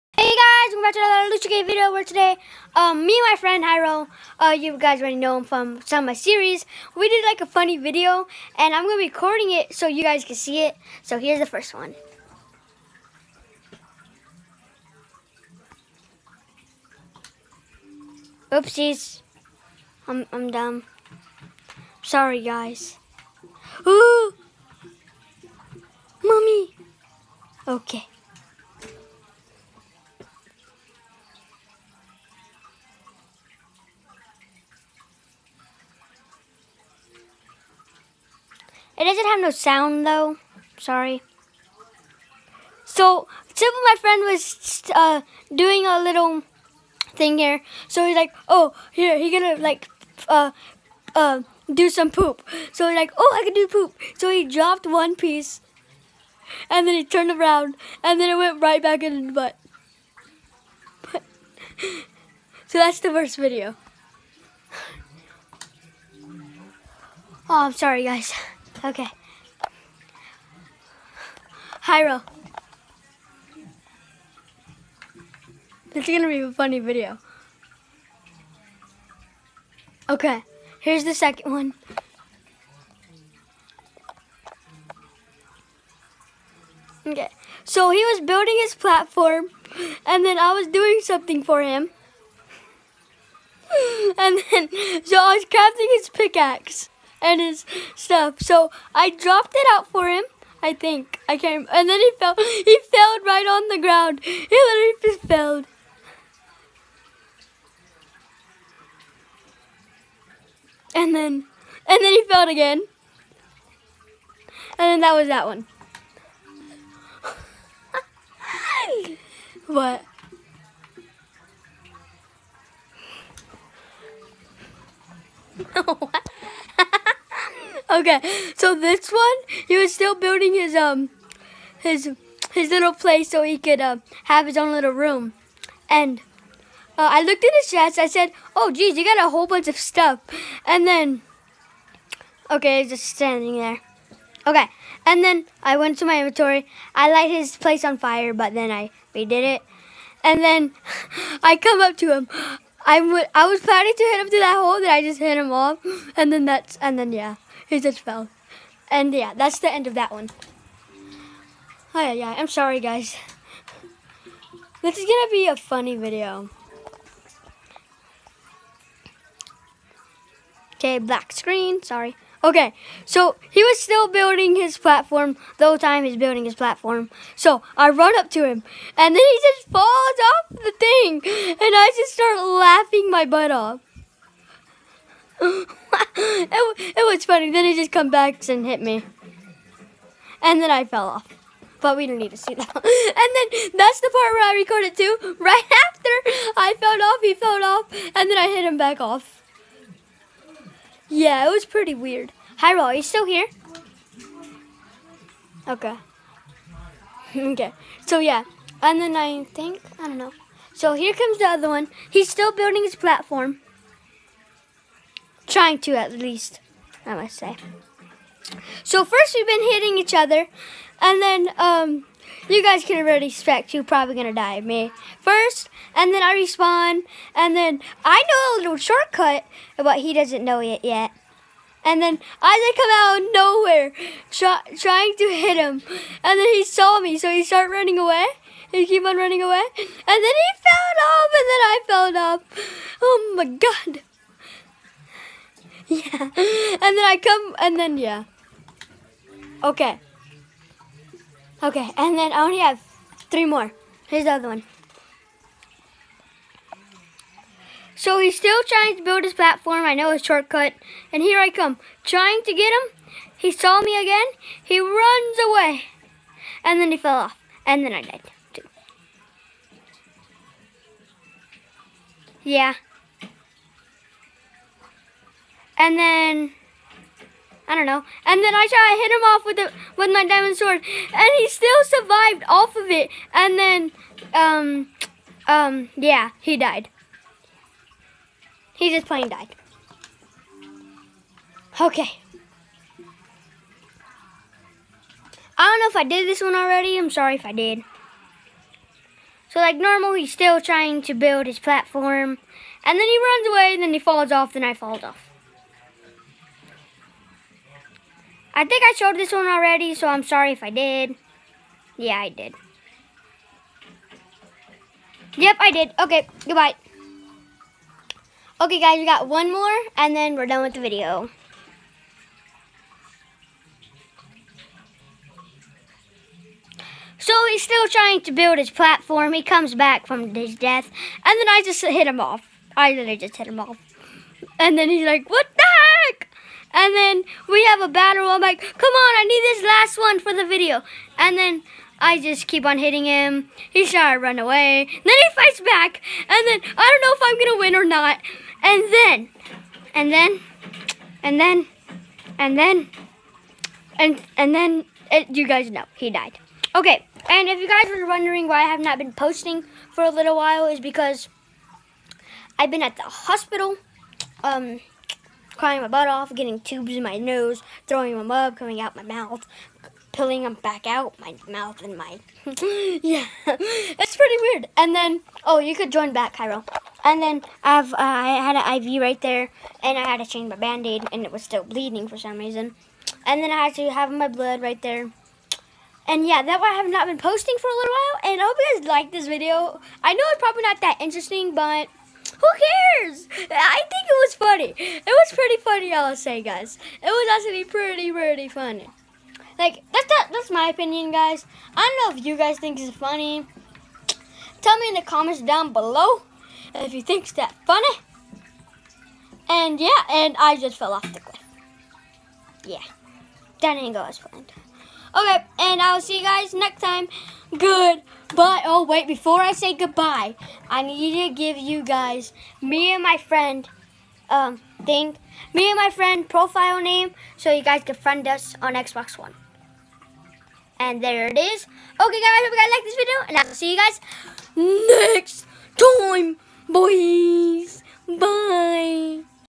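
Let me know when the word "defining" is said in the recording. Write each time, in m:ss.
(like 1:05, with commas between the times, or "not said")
not said.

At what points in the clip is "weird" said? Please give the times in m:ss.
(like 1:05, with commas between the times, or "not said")
3:21, 6:14.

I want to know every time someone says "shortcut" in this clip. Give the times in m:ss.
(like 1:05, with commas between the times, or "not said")
3:48, 4:20.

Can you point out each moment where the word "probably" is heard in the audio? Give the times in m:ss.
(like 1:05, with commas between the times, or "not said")
3:43, 6:30.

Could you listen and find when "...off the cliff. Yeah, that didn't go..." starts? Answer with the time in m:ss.
6:50.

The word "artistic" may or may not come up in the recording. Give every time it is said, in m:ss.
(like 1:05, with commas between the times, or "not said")
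not said.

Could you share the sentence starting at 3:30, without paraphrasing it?
So here comes the other one.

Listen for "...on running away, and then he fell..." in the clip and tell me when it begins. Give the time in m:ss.
3:59.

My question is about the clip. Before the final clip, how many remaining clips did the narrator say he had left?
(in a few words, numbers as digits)
3.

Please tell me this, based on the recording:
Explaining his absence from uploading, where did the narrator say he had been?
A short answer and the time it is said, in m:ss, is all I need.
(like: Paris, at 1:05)
the hospital, at 6:02.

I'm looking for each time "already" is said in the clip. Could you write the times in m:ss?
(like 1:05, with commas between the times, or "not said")
0:04, 3:43, 4:56, 5:09.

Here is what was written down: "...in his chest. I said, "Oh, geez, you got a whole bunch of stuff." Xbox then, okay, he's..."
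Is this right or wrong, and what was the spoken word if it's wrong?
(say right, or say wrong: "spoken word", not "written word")
wrong: "And", not "Xbox".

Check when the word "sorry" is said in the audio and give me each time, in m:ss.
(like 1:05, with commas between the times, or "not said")
0:22, 0:40, 1:07, 2:42, 2:51, 4:57, 5:10.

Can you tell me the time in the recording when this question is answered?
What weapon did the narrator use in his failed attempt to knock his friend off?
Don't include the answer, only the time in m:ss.
4:40.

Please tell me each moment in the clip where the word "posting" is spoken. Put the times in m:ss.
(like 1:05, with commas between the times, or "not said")
5:59, 6:27.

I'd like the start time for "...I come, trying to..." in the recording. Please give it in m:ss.
4:21.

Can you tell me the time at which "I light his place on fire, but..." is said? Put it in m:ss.
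2:26.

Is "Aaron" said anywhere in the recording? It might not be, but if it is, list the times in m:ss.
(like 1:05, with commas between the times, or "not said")
not said.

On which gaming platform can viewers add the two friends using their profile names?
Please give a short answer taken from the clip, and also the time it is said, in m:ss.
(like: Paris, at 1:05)
Xbox One, at 7:08.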